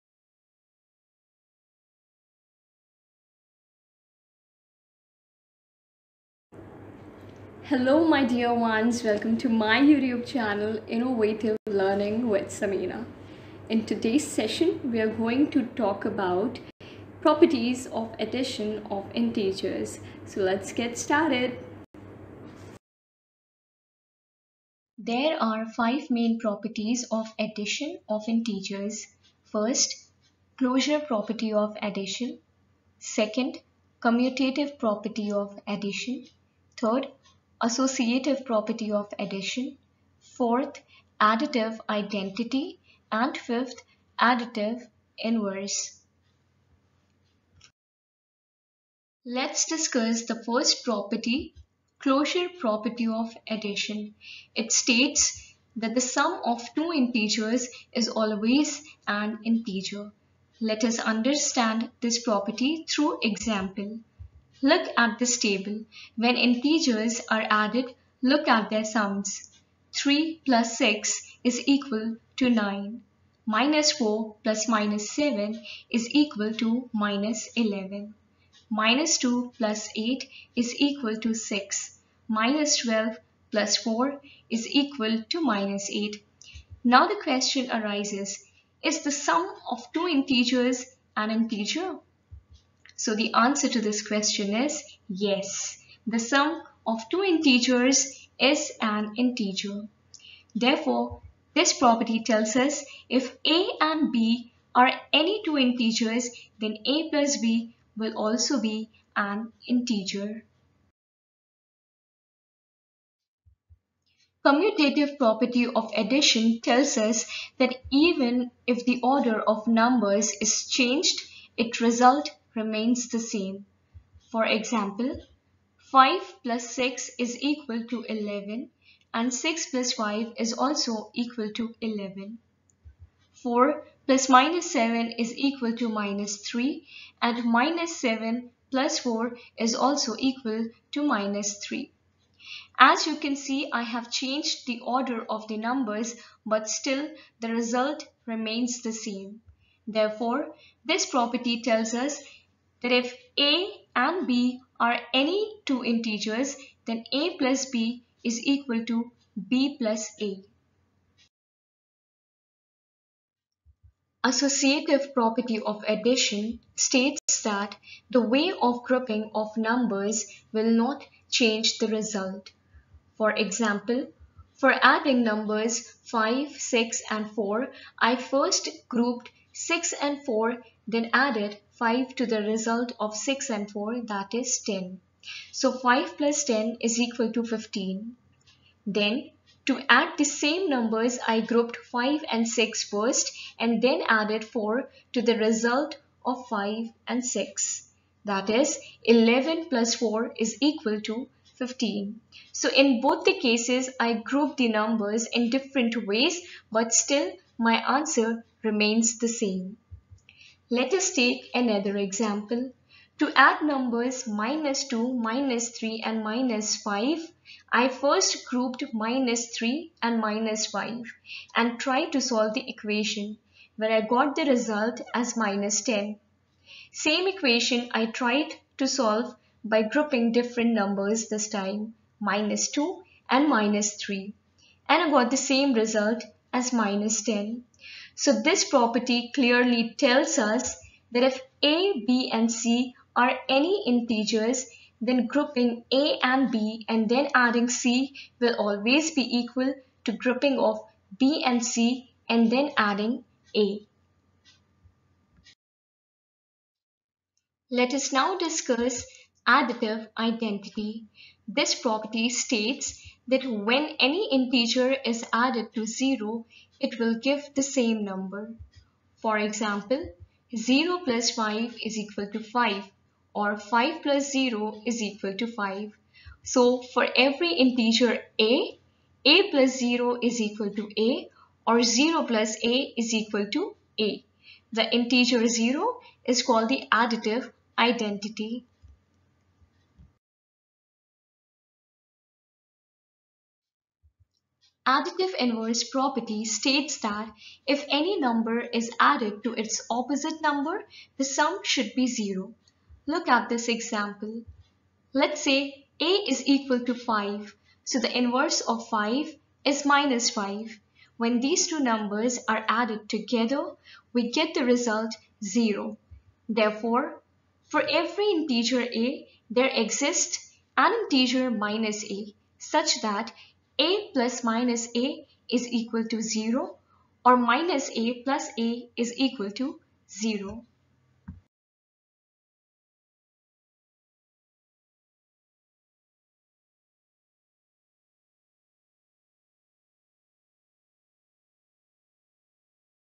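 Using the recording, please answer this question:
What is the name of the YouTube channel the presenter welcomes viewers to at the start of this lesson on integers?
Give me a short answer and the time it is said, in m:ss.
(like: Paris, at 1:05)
Innovative Learning with Sameena, at 0:10.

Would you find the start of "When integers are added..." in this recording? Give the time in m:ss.
1:06.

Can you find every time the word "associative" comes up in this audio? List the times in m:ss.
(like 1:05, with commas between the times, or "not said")
0:37, 2:44.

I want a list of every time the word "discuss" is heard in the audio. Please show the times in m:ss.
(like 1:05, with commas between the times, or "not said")
0:49, 4:18.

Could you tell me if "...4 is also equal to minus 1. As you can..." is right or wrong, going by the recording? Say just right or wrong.
wrong.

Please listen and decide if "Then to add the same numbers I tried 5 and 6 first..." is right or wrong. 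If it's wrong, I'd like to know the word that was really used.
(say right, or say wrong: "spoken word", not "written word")
wrong: "grouped", not "tried".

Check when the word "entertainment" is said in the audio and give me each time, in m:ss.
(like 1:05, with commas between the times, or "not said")
not said.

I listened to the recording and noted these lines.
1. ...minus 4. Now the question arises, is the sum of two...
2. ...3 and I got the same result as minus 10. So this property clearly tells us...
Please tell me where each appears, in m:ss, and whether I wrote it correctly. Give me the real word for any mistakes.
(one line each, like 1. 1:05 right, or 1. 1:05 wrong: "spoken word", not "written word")
1. 1:25 wrong: "8", not "4"
2. 3:53 right.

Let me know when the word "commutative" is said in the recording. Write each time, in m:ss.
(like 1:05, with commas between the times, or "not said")
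0:34, 1:54.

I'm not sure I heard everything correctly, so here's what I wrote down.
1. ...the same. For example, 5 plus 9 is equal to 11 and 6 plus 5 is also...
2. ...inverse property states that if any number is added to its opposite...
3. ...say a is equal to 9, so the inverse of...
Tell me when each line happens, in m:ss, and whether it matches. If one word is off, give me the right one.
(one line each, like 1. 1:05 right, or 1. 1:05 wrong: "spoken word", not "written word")
1. 2:03 wrong: "6", not "9"
2. 4:55 right
3. 5:05 wrong: "5", not "9".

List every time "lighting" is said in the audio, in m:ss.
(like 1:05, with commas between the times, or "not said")
not said.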